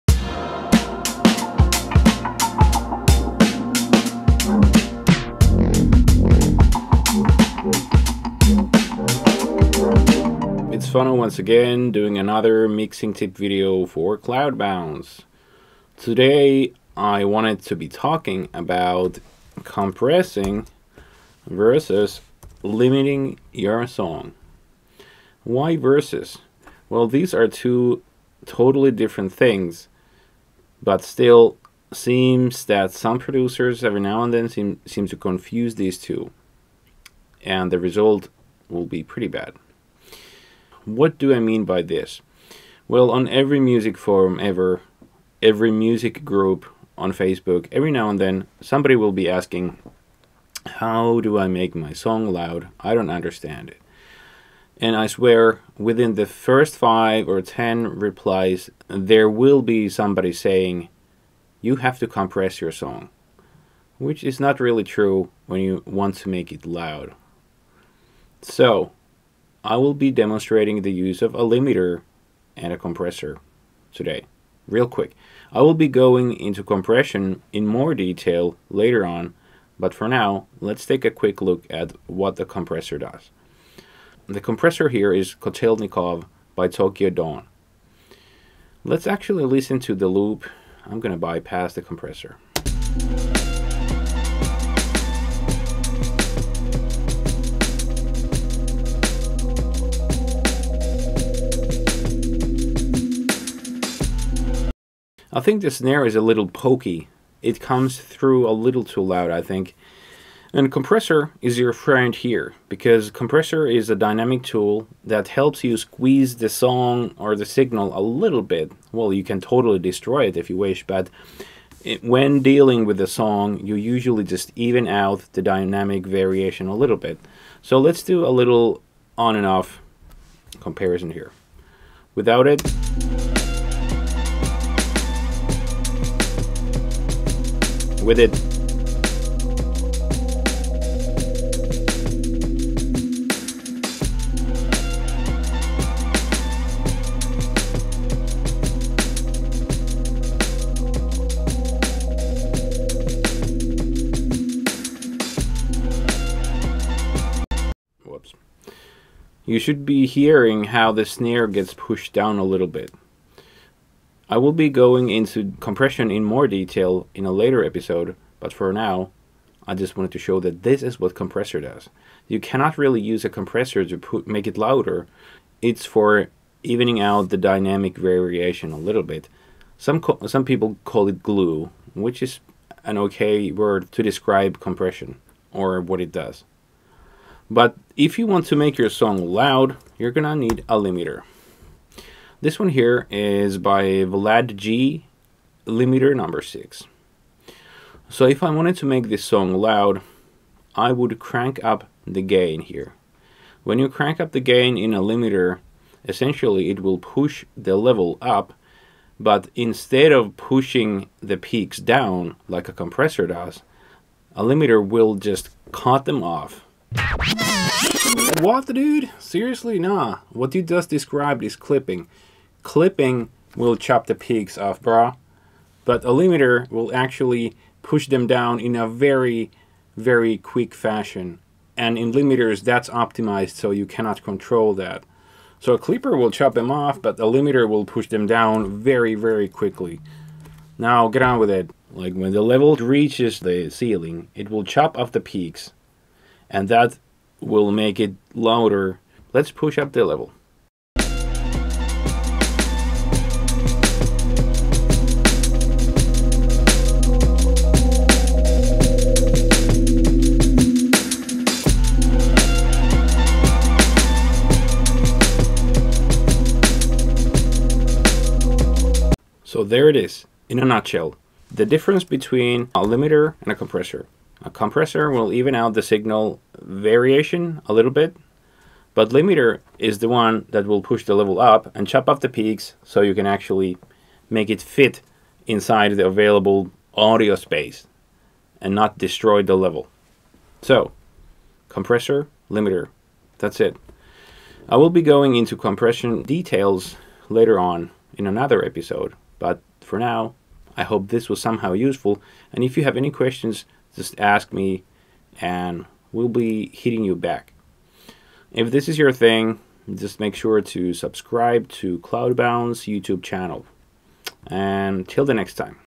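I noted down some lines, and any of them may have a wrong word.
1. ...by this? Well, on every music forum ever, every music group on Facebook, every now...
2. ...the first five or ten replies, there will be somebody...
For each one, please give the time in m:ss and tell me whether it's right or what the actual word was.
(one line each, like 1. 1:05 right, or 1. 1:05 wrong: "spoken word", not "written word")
1. 0:41 right
2. 0:56 right.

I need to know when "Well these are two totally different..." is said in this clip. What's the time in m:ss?
0:26.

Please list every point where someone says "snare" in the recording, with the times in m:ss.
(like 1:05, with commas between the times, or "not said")
1:45, 2:41.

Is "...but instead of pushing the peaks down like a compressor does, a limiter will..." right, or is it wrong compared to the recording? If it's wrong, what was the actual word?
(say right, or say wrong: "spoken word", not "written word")
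right.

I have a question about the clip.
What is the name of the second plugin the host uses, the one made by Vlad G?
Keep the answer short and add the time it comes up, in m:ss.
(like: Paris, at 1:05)
Limiter No. 6, at 3:15.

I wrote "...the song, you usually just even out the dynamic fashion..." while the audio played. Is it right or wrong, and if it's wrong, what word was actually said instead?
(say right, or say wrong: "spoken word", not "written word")
wrong: "variation", not "fashion".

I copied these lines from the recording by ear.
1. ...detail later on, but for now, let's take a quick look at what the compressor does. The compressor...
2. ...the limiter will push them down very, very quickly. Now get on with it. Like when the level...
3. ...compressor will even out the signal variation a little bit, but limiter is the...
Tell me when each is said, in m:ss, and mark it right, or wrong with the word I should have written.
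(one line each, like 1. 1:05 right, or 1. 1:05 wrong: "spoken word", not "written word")
1. 1:17 right
2. 3:57 right
3. 4:34 right.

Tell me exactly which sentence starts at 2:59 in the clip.
Some, some people call it glue, which is an okay word to describe compression or what it does.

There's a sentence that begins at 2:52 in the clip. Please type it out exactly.
You cannot really use a compressor to put, make it louder.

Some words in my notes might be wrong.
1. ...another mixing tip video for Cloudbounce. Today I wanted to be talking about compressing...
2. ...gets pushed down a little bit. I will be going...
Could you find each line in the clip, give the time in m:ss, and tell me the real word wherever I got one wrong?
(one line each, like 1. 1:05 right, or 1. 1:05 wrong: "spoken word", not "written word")
1. 0:12 right
2. 2:41 right.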